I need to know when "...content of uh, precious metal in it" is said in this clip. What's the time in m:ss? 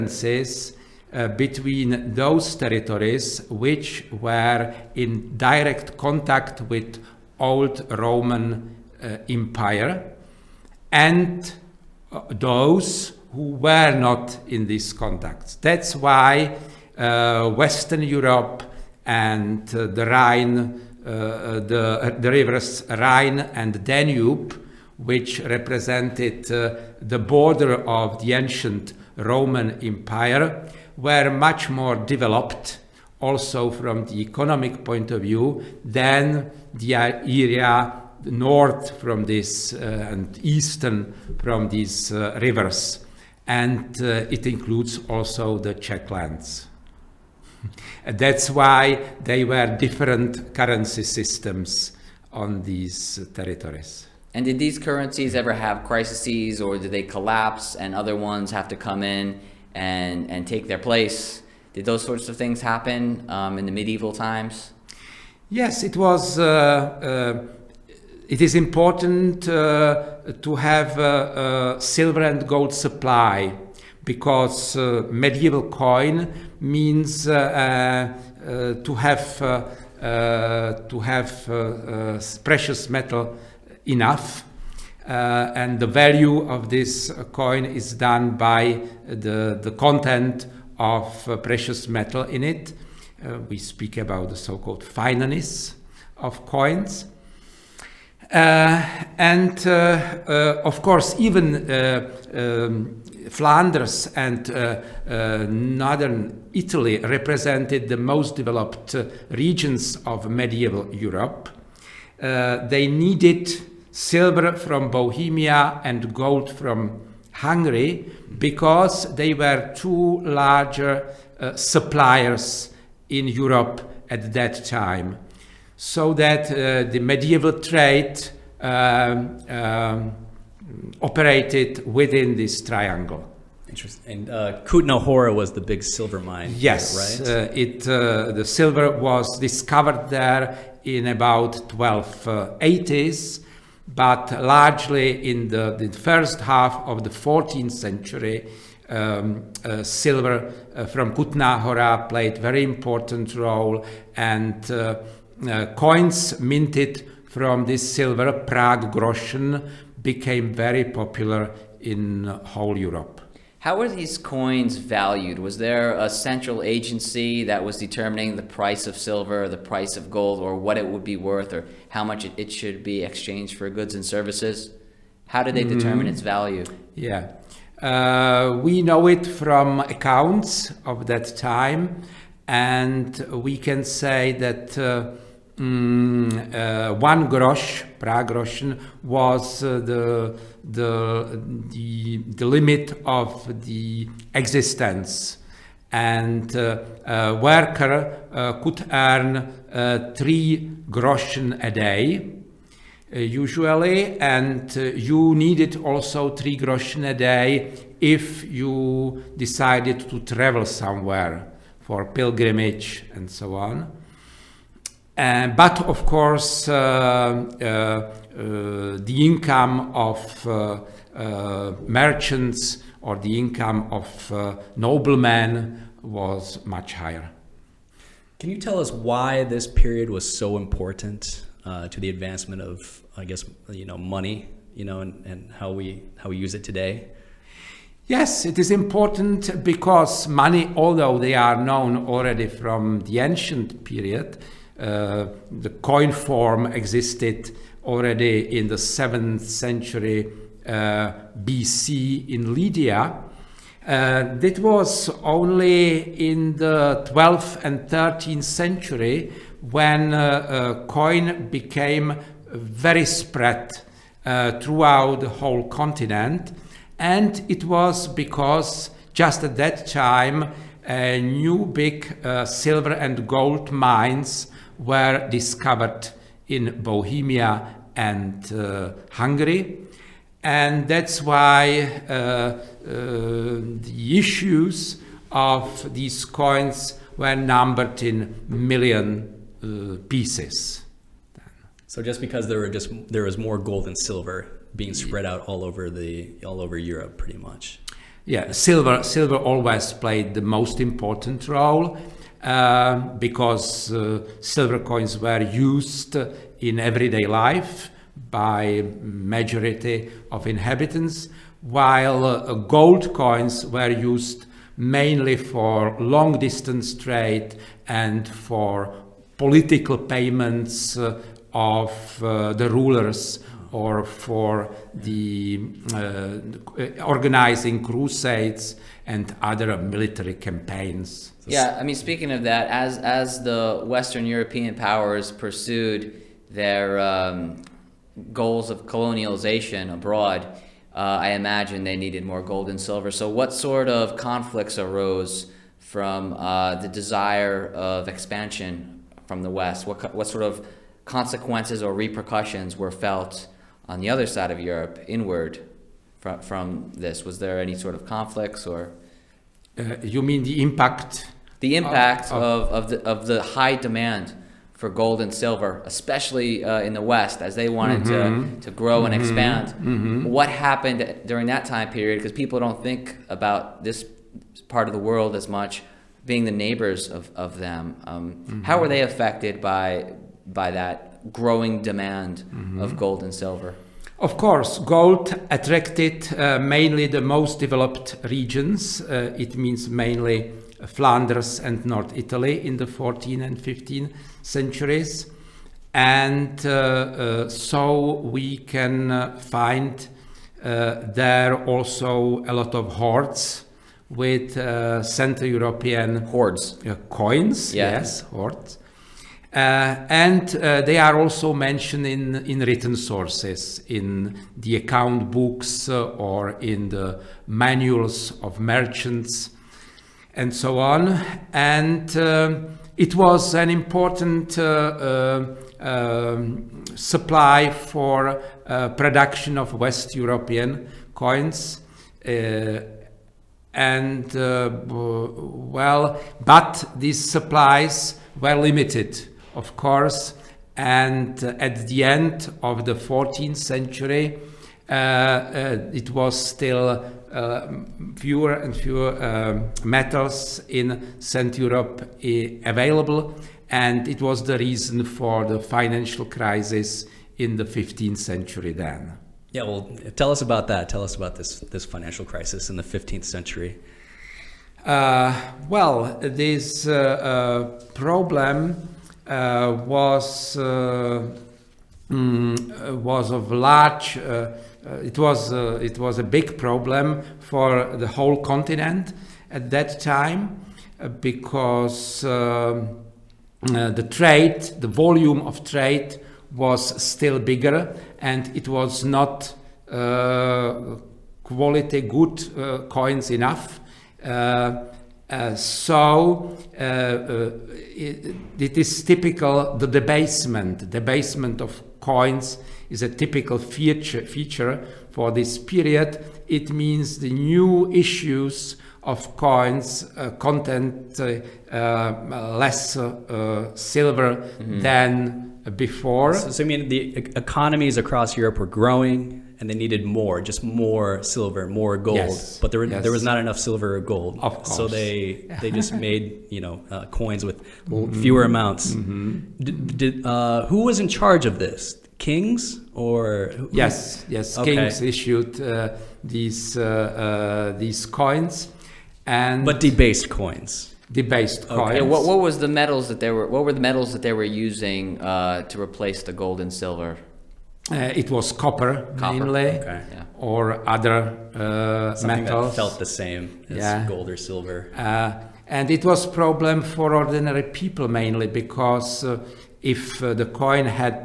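1:29.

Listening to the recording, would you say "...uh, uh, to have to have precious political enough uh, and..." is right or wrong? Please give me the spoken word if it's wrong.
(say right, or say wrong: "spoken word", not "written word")
wrong: "metal", not "political".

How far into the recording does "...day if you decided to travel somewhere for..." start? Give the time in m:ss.
3:27.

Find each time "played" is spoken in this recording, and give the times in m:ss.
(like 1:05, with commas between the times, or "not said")
2:32, 4:59.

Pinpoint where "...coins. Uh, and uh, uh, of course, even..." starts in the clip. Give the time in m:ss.
1:36.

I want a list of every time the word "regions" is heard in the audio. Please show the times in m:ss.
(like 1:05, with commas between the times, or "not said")
1:49, 6:28.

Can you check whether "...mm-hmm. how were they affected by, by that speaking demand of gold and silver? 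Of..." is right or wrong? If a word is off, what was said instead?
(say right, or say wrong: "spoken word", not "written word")
wrong: "growing", not "speaking".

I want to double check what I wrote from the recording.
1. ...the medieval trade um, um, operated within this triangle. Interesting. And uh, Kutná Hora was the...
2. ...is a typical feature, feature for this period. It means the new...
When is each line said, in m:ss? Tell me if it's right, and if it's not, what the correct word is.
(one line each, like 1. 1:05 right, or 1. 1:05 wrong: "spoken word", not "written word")
1. 2:06 right
2. 8:22 right.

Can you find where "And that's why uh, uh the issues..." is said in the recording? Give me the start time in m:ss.
4:40.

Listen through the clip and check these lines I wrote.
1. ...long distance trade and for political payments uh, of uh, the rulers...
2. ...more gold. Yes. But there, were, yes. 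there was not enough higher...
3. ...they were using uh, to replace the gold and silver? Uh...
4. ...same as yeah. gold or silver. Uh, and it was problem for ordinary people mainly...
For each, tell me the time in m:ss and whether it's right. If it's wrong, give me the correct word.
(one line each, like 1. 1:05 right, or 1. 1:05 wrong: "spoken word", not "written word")
1. 5:16 right
2. 8:41 wrong: "silver", not "higher"
3. 9:04 right
4. 9:13 right.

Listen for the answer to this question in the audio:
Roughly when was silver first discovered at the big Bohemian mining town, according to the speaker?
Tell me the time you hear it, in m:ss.
2:21.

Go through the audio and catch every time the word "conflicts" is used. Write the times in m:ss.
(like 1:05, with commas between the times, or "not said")
5:44, 5:58.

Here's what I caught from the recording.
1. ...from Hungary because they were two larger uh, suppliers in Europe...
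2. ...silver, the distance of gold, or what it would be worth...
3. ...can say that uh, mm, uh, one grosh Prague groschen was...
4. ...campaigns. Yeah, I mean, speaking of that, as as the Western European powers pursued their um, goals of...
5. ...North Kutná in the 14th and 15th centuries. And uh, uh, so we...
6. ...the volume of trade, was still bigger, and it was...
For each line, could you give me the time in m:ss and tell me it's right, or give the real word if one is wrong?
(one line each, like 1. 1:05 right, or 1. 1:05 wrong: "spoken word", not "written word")
1. 1:56 right
2. 2:48 wrong: "price", not "distance"
3. 3:03 right
4. 5:30 right
5. 6:31 wrong: "Italy", not "Kutná"
6. 8:04 right.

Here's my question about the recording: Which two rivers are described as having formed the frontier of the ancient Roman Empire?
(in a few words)
Rhine and Danube.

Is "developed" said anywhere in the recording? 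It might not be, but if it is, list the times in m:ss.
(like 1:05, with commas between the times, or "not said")
0:31, 1:48, 6:27.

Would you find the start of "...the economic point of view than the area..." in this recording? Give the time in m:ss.
0:34.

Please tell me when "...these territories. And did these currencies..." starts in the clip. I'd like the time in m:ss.
0:52.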